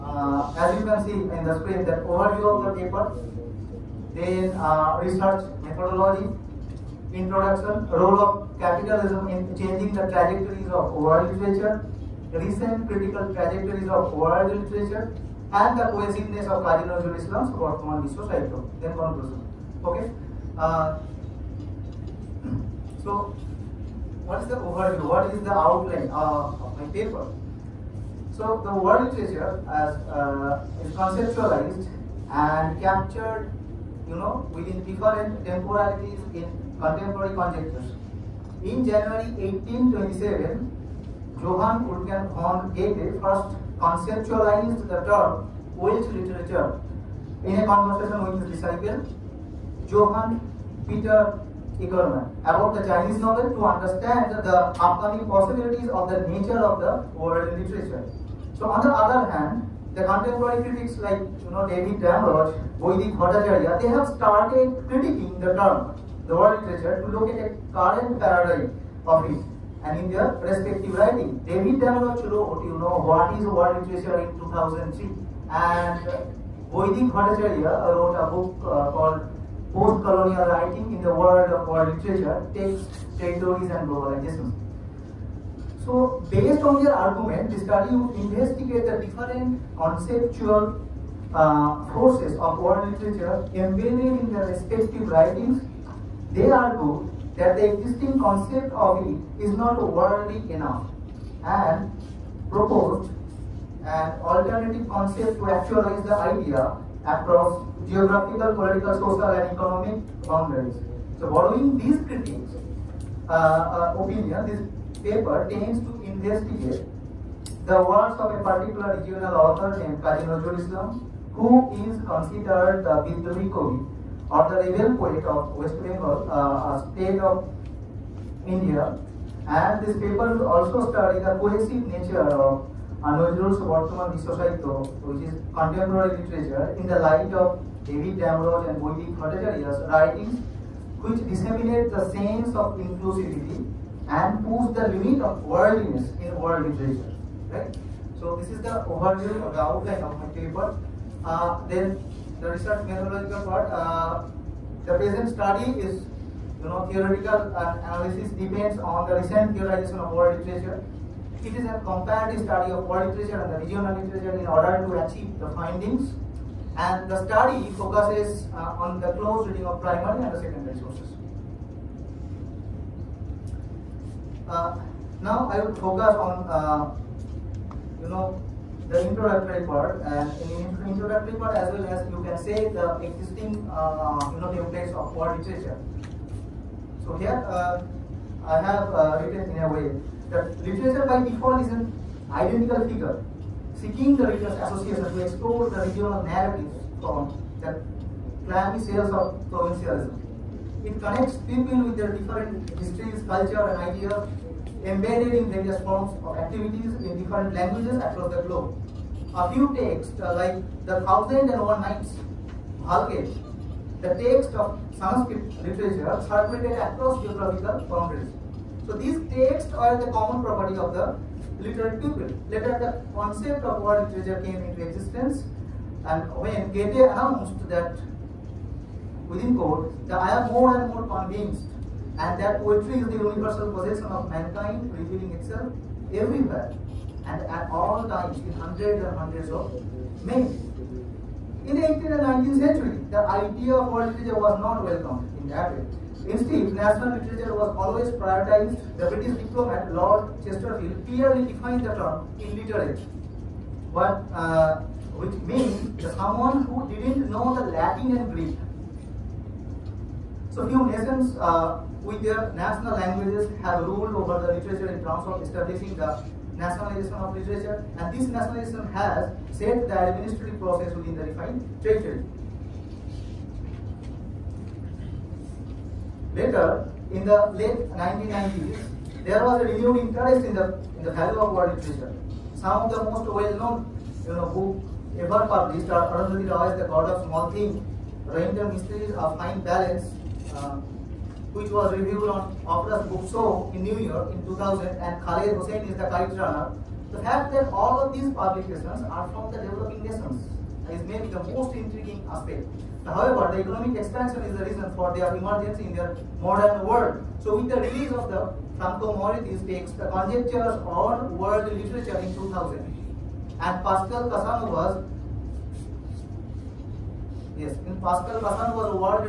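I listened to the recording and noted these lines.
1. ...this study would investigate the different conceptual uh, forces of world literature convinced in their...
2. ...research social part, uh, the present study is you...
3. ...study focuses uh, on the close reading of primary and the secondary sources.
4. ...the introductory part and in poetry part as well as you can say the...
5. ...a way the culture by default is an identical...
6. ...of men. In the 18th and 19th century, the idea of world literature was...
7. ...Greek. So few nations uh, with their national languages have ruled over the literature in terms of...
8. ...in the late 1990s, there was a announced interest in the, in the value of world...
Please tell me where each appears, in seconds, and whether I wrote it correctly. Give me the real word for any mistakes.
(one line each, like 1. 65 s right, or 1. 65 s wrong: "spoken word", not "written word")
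1. 87 s wrong: "embedded", not "convinced"
2. 152 s wrong: "methodological", not "social"
3. 167 s right
4. 178 s wrong: "introductory", not "poetry"
5. 189 s wrong: "literature", not "culture"
6. 239 s right
7. 258 s right
8. 277 s wrong: "renewed", not "announced".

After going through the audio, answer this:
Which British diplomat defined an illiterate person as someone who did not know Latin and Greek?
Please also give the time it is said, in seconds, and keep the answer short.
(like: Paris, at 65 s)
Lord Chesterfield, at 249 s.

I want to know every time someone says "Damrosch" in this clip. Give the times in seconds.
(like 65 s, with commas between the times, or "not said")
61 s, 71 s, 138 s.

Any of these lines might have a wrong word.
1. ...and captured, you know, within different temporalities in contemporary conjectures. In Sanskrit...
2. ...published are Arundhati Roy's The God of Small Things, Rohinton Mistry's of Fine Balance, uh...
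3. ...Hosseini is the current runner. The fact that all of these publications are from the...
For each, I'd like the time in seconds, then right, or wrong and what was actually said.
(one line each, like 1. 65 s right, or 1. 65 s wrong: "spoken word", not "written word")
1. 32 s wrong: "January", not "Sanskrit"
2. 285 s right
3. 295 s right.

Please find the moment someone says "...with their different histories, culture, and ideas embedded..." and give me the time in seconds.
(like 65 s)
201 s.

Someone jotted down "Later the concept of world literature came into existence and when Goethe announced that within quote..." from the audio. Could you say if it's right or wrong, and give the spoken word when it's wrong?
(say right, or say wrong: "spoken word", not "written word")
right.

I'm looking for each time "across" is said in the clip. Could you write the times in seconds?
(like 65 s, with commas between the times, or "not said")
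107 s, 207 s, 216 s.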